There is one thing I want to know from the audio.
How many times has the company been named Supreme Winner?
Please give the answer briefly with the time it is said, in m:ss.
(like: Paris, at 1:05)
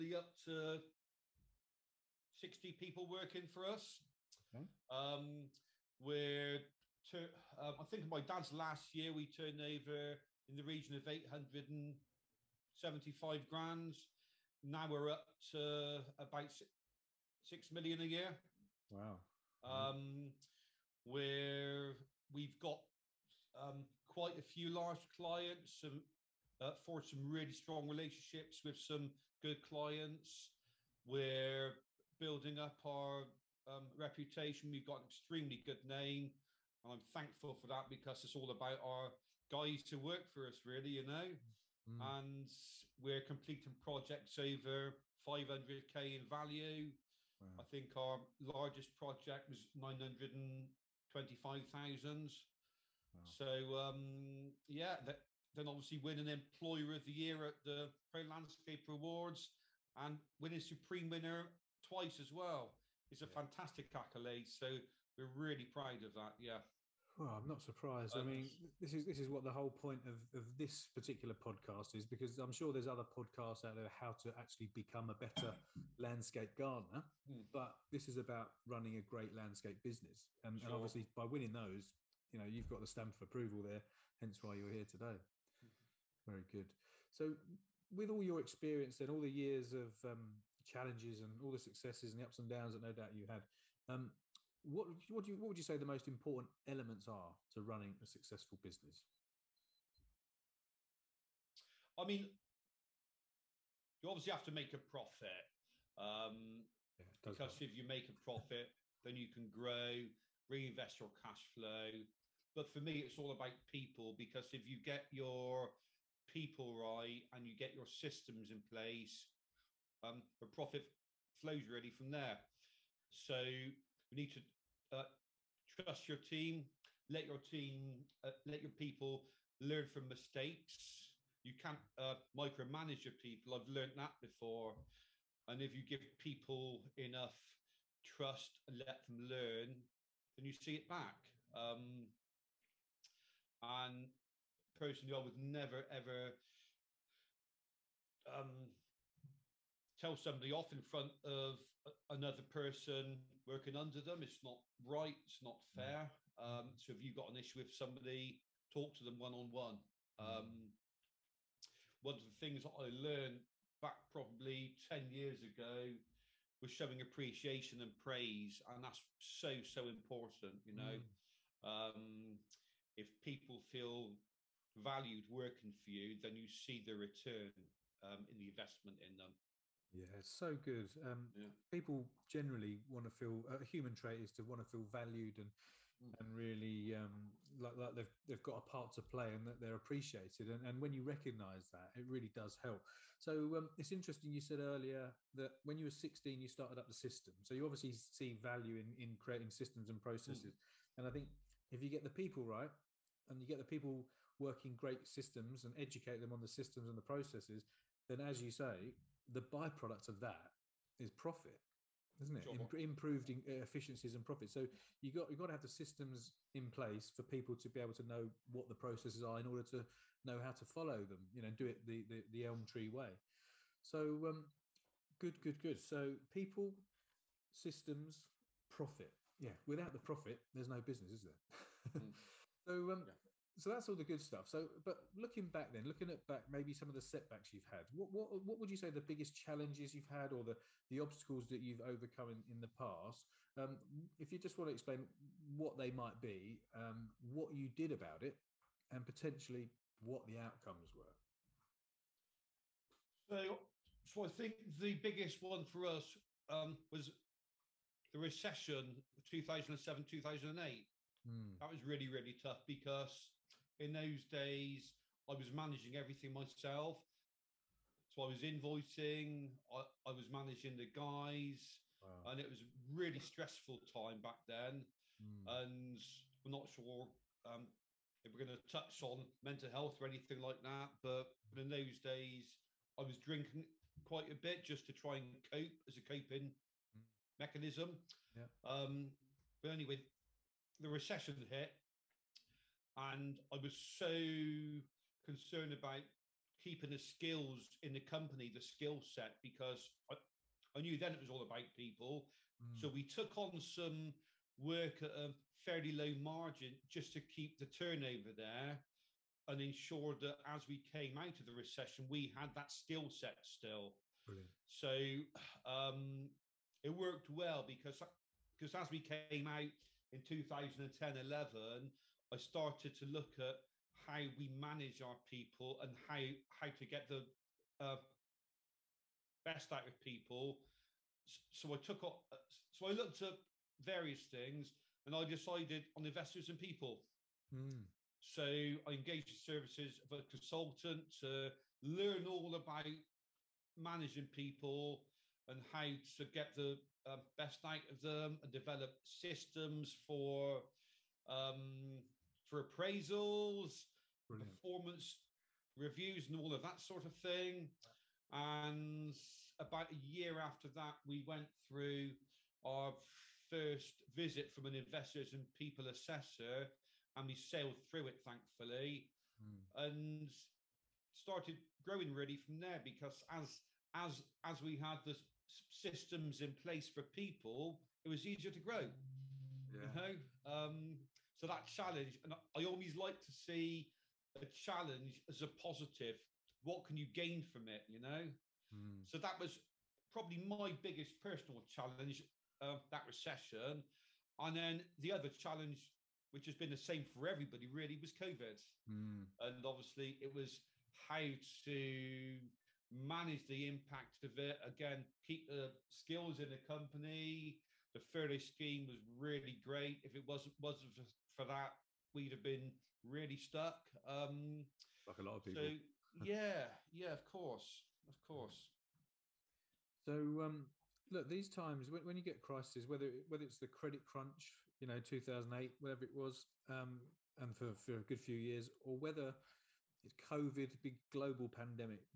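twice, at 1:01.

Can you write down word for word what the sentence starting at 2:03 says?
So we need to uh, trust your team, let your team, uh, let your people learn from mistakes.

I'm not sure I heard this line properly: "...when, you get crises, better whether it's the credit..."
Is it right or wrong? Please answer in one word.
wrong.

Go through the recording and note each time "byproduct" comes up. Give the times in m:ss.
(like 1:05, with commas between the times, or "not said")
3:29.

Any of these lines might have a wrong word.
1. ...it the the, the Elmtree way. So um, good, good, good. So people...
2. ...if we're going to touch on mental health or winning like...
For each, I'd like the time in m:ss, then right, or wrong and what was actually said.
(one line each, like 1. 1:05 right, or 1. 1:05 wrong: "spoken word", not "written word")
1. 3:41 right
2. 4:38 wrong: "anything", not "winning".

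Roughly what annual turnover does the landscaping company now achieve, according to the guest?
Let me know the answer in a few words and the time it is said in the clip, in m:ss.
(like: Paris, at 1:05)
about £6 million, at 0:16.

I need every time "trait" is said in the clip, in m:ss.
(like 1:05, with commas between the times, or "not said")
3:03.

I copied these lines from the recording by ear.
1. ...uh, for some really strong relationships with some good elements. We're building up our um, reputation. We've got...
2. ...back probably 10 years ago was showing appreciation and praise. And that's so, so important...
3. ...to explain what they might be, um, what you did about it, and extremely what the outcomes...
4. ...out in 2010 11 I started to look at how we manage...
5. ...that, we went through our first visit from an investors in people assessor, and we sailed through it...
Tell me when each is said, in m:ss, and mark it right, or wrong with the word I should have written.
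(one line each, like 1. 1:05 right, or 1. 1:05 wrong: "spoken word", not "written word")
1. 0:26 wrong: "clients", not "elements"
2. 2:43 right
3. 4:04 wrong: "potentially", not "extremely"
4. 5:19 right
5. 6:00 right.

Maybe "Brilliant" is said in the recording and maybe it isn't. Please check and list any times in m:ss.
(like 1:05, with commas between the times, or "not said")
5:14, 5:54.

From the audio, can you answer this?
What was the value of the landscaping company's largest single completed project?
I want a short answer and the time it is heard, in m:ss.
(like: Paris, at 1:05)
925,000, at 0:49.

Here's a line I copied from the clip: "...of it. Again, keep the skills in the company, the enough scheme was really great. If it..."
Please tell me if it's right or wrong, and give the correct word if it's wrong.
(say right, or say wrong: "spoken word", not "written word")
wrong: "furlough", not "enough".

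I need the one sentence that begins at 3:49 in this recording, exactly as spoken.
Yeah, without the profit, there's no business, is there?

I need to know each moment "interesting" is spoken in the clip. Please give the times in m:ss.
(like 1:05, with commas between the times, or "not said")
3:13.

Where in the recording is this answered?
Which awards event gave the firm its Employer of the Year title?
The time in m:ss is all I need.
0:58.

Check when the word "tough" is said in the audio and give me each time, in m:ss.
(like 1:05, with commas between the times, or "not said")
4:22.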